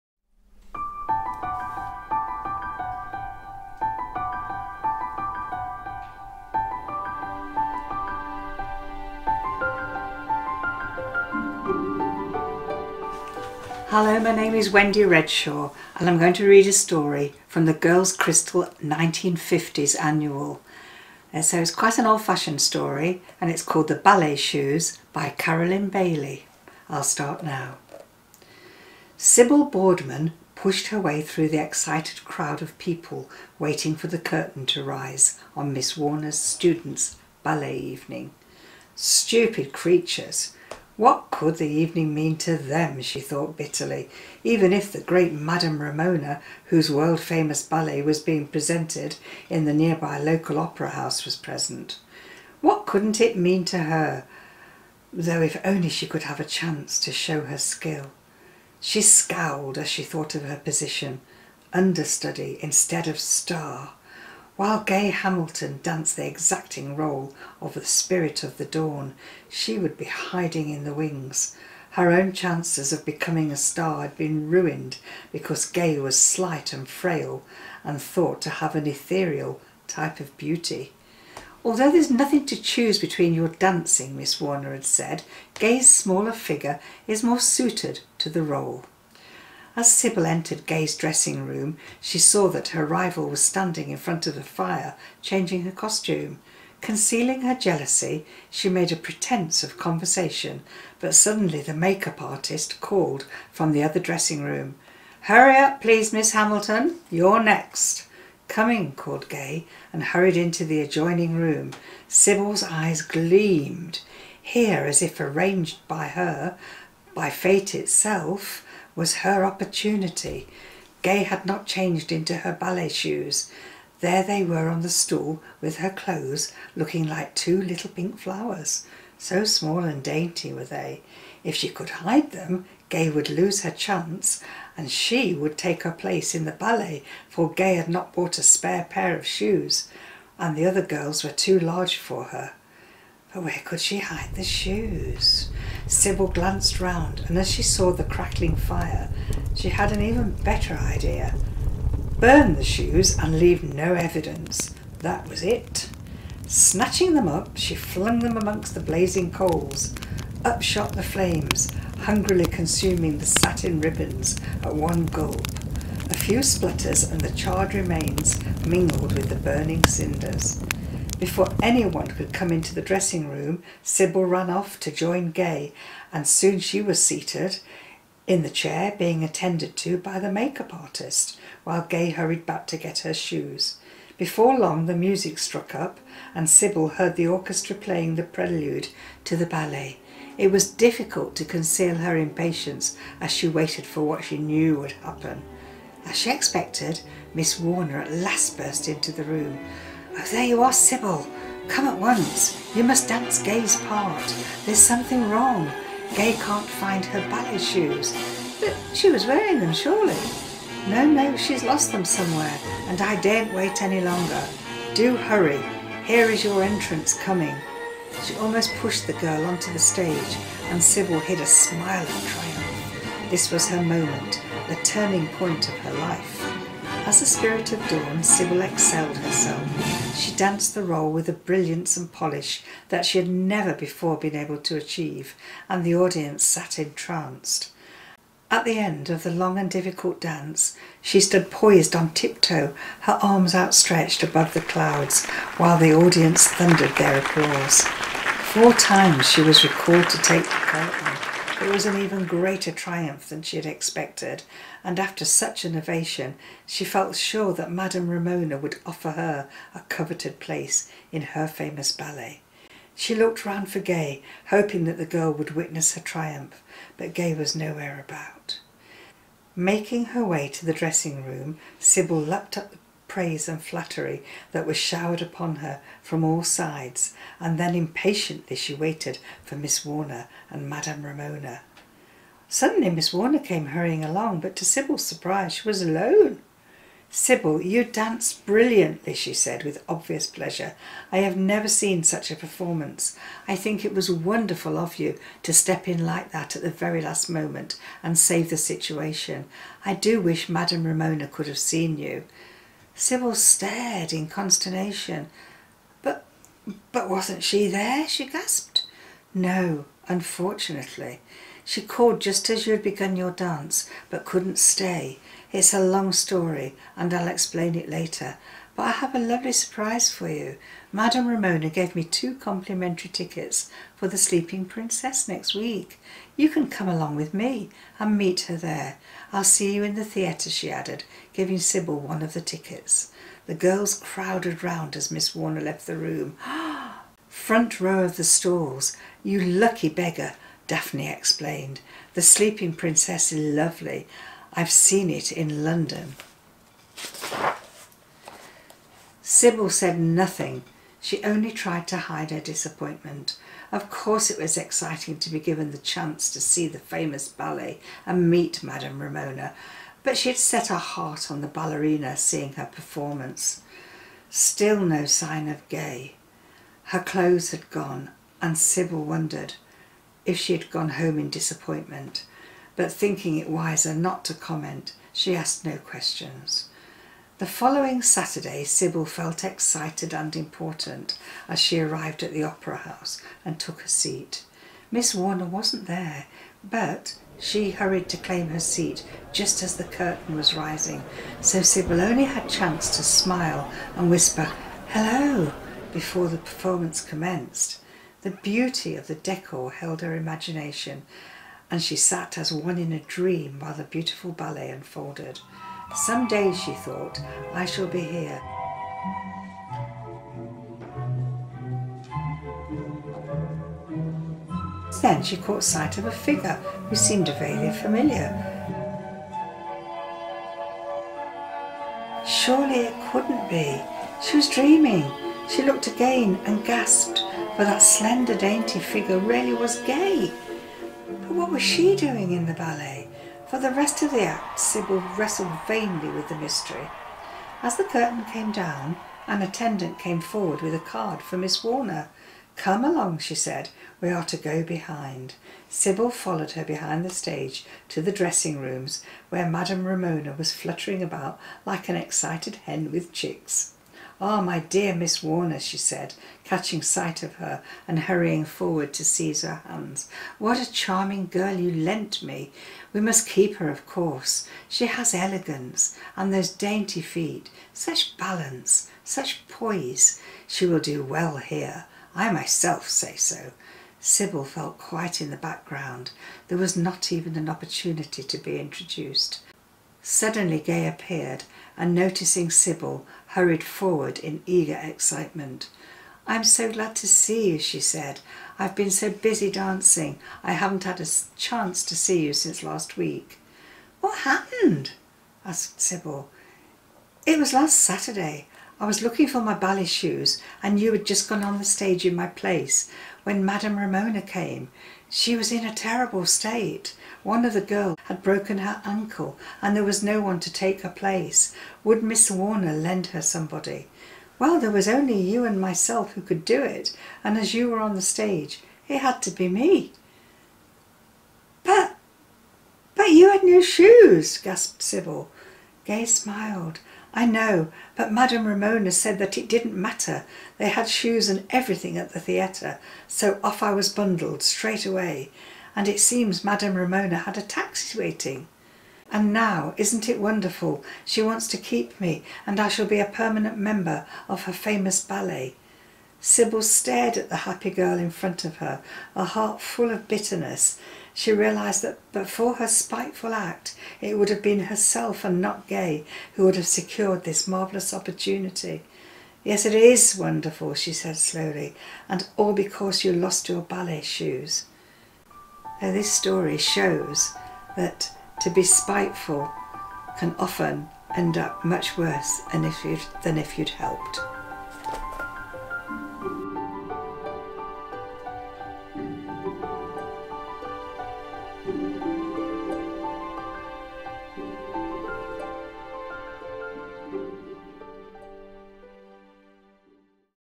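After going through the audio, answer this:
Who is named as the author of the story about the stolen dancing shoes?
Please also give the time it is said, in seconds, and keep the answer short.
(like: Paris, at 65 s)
Carolyn Bailey, at 25 s.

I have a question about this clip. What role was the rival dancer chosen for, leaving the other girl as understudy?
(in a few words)
spirit of the dawn.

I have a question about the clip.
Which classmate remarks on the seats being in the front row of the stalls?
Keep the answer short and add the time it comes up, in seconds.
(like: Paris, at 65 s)
Daphne, at 340 s.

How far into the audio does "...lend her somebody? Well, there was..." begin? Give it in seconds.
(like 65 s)
512 s.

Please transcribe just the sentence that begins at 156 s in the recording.
Snatching them up, she flung them amongst the blazing coals.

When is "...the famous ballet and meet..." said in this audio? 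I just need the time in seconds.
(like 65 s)
356 s.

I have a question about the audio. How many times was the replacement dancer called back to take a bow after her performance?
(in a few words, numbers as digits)
4.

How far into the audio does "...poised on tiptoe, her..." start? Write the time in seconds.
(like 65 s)
241 s.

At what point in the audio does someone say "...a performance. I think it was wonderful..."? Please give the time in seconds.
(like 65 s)
292 s.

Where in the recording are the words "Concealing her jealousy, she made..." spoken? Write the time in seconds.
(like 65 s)
96 s.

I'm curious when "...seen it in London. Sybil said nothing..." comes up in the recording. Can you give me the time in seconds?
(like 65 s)
344 s.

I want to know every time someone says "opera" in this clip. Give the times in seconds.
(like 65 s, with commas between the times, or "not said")
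50 s, 382 s.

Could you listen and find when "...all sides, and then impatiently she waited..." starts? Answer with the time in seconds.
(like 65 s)
276 s.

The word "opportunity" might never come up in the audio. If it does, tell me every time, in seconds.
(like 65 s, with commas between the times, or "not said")
119 s, 477 s, 557 s.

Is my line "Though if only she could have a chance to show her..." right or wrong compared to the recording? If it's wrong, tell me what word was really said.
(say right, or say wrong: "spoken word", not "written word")
right.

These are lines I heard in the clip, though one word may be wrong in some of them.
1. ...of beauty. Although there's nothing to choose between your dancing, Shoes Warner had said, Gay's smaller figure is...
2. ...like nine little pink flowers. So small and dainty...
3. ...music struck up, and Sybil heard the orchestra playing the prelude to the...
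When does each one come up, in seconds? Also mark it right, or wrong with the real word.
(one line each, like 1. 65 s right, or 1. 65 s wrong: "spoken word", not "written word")
1. 80 s wrong: "Miss", not "Shoes"
2. 127 s wrong: "two", not "nine"
3. 184 s right.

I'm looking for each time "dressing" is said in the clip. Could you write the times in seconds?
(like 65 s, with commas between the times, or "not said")
90 s, 103 s, 172 s, 270 s, 448 s.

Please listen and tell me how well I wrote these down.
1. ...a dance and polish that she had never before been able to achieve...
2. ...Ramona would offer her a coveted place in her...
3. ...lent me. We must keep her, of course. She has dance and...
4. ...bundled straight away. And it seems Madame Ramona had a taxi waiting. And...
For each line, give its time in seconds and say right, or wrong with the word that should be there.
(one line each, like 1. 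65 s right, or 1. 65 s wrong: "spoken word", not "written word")
1. 231 s wrong: "brilliance", not "dance"
2. 258 s right
3. 461 s wrong: "elegance", not "dance"
4. 533 s right.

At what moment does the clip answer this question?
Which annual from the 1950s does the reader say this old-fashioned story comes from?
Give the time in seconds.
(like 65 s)
17 s.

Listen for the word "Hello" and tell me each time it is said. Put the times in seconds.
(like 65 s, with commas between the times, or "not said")
13 s, 394 s.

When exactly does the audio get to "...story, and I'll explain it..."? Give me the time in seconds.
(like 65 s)
316 s.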